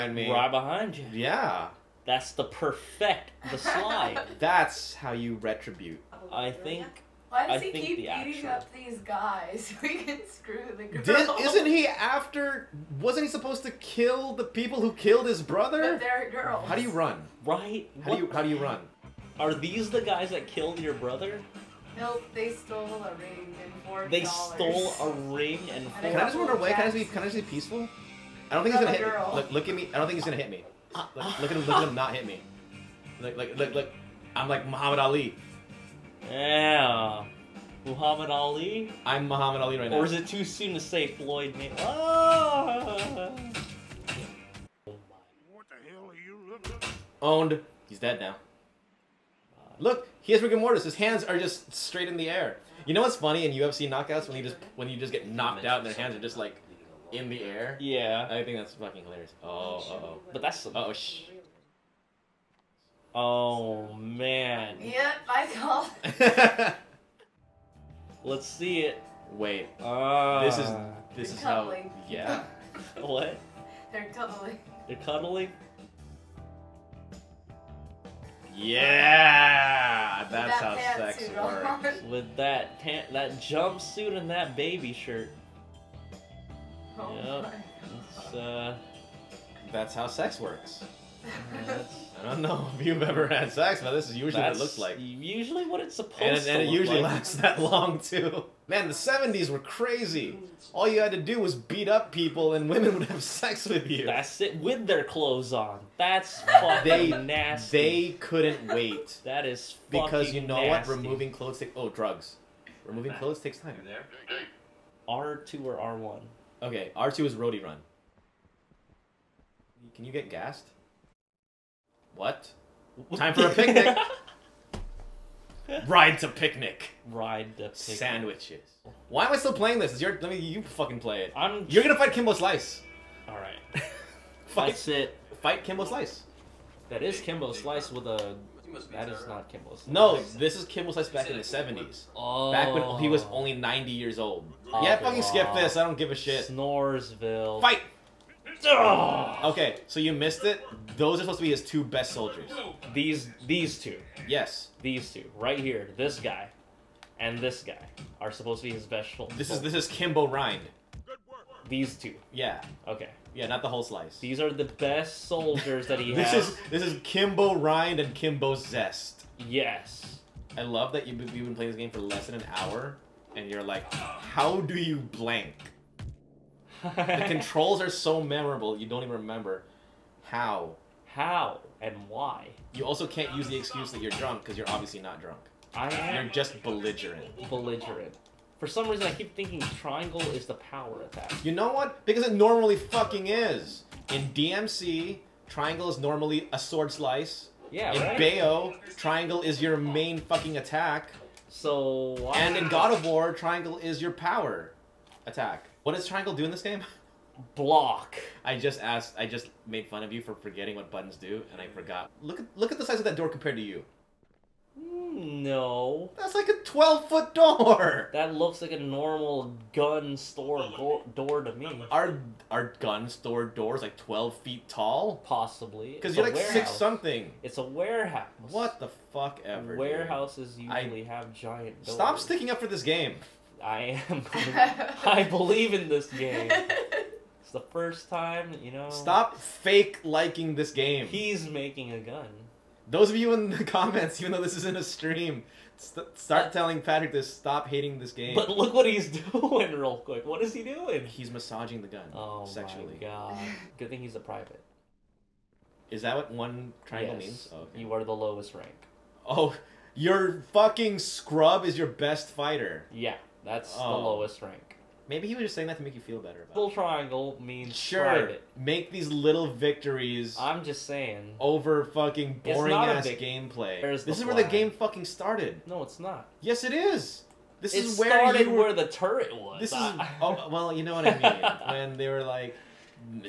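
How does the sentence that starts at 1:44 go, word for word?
That's it, with their clothes on.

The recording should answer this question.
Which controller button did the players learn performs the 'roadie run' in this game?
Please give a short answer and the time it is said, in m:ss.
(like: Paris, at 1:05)
R2, at 1:56.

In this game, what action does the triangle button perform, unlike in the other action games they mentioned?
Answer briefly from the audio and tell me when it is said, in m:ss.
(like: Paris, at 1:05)
Block, at 3:27.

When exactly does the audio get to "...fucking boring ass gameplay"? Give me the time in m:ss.
4:31.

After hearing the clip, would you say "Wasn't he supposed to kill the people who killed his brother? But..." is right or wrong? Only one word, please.
right.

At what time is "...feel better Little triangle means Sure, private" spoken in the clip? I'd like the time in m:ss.
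4:26.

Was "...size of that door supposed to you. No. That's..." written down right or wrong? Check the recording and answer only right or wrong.
wrong.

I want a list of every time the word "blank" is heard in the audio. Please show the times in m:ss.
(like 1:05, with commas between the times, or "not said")
2:54.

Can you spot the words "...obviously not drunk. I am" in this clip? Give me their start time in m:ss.
3:04.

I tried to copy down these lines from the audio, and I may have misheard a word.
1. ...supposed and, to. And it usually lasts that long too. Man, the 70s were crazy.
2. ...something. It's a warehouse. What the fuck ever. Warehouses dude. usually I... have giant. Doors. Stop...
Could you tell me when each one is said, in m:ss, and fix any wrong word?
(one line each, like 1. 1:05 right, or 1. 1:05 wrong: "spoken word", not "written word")
1. 1:35 right
2. 3:46 right.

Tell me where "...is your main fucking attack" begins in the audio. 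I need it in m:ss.
3:19.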